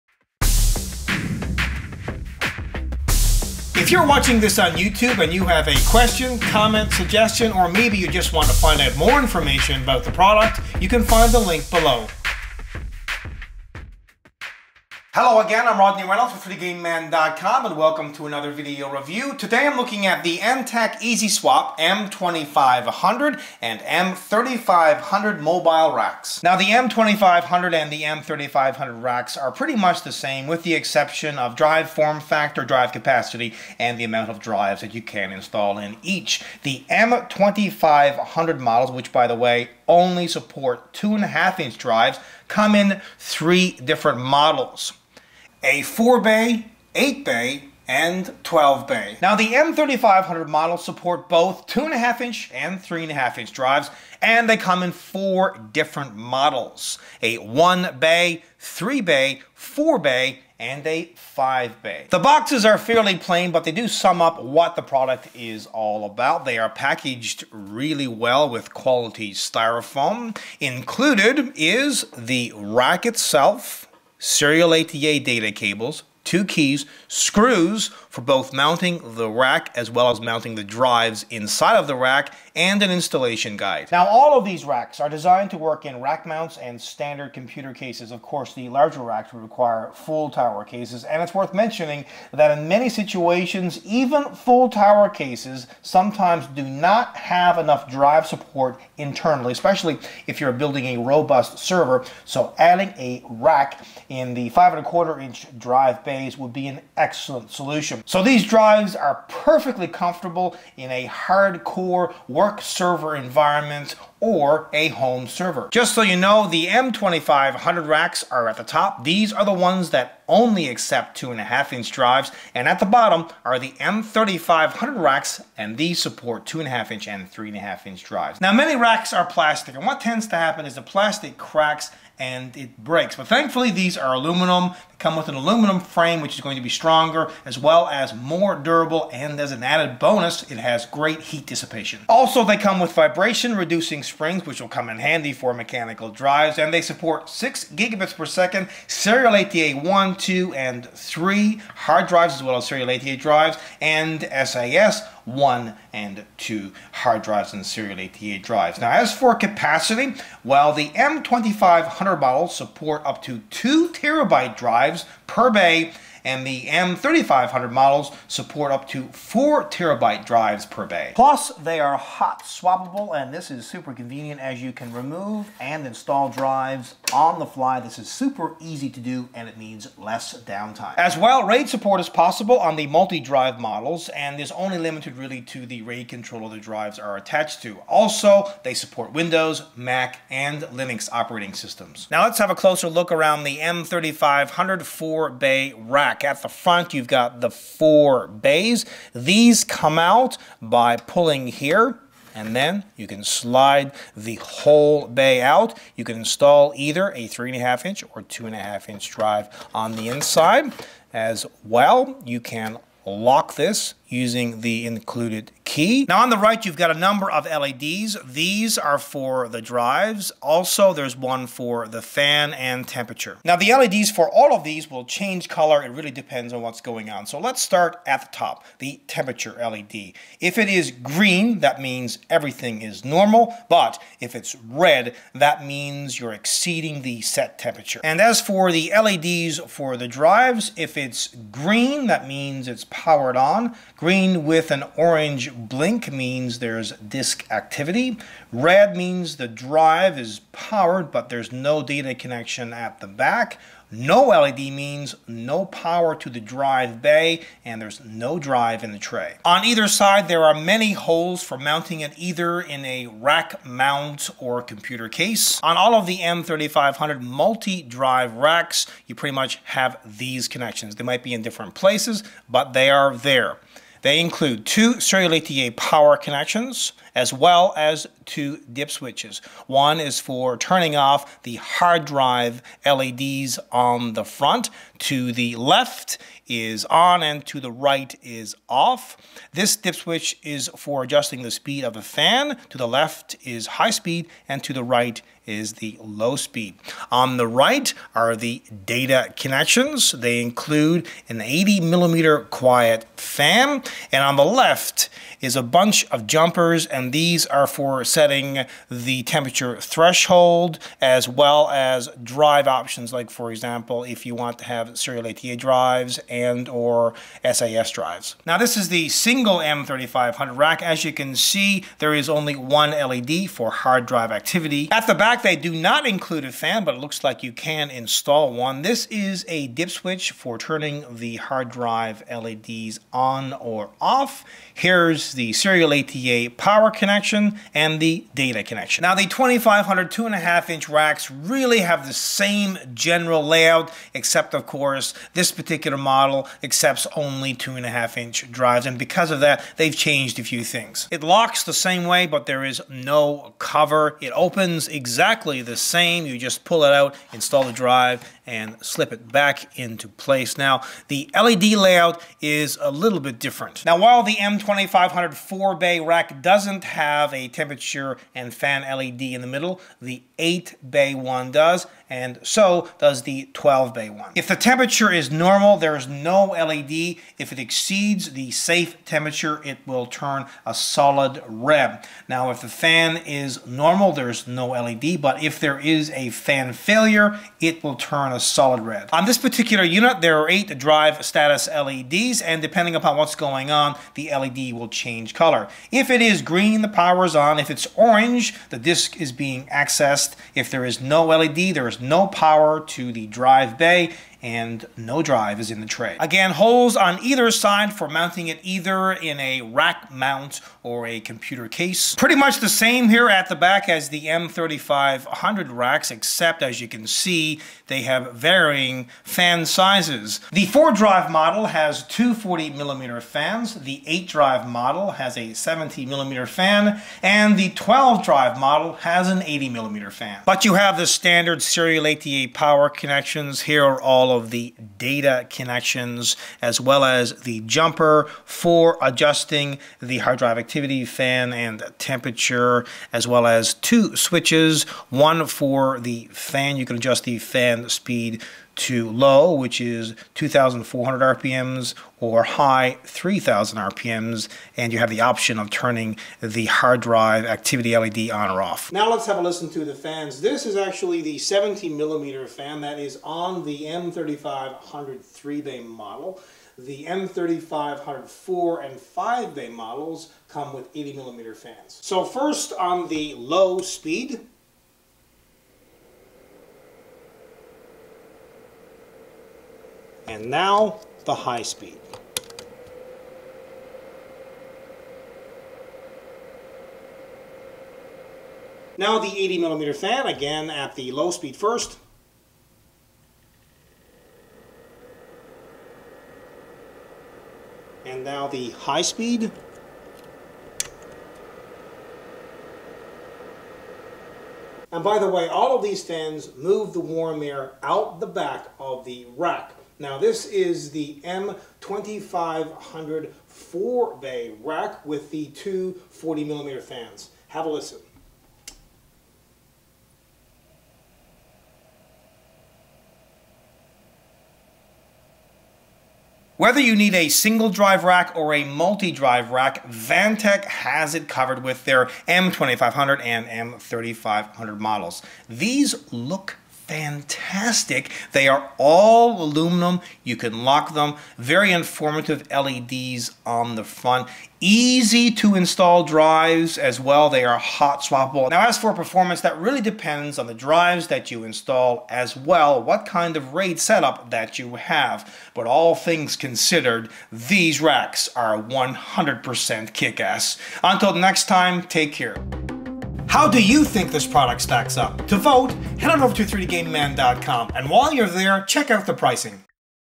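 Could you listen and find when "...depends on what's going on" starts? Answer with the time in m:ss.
3:46.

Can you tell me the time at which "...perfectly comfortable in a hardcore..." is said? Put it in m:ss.
1:49.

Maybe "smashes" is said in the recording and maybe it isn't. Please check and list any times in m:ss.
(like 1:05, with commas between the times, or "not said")
not said.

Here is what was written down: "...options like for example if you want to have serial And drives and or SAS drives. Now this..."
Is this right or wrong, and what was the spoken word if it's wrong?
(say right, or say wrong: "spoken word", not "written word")
wrong: "ATA", not "And".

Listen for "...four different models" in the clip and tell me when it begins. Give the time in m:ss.
0:54.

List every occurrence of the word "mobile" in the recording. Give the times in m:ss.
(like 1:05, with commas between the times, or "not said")
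0:25.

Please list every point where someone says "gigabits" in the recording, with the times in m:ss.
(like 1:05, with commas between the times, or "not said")
2:27.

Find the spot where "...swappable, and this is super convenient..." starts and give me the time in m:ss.
2:52.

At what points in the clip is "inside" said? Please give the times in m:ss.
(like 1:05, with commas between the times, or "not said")
1:21, 3:30.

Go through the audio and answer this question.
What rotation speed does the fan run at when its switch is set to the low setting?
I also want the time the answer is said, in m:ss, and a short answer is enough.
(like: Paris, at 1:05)
2,400 RPM, at 7:30.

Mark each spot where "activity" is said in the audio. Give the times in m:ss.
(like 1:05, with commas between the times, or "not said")
4:07, 5:24, 7:20, 7:37.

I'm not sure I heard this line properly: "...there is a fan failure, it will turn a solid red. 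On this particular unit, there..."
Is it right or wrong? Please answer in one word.
right.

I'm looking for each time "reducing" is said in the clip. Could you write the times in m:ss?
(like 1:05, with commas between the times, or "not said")
2:23.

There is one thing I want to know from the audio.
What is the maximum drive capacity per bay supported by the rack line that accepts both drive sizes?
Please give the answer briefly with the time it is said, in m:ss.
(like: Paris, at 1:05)
4 terabytes, at 2:49.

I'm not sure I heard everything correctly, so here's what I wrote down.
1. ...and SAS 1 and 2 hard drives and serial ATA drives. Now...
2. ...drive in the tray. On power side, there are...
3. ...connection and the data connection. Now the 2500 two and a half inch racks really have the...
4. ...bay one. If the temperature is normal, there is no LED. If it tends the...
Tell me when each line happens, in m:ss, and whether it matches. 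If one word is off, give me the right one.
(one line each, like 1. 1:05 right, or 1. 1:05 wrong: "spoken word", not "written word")
1. 2:33 right
2. 4:18 wrong: "either", not "power"
3. 5:36 right
4. 6:13 wrong: "exceeds", not "tends".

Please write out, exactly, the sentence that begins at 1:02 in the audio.
The boxes are fairly plain, but they do sum up what the product is all about.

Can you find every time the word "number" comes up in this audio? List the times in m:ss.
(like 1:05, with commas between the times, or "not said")
3:36.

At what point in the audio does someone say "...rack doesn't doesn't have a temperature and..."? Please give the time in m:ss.
6:05.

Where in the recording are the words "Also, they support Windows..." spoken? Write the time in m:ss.
3:07.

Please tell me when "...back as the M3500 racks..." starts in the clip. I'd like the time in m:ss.
6:53.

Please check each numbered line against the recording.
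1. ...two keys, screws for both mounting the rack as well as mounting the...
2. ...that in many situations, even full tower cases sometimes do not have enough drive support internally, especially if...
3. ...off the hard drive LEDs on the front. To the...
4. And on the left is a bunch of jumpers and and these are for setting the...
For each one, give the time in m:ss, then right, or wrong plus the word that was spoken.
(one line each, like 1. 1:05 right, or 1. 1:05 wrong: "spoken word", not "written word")
1. 1:16 right
2. 1:32 right
3. 4:40 right
4. 5:04 right.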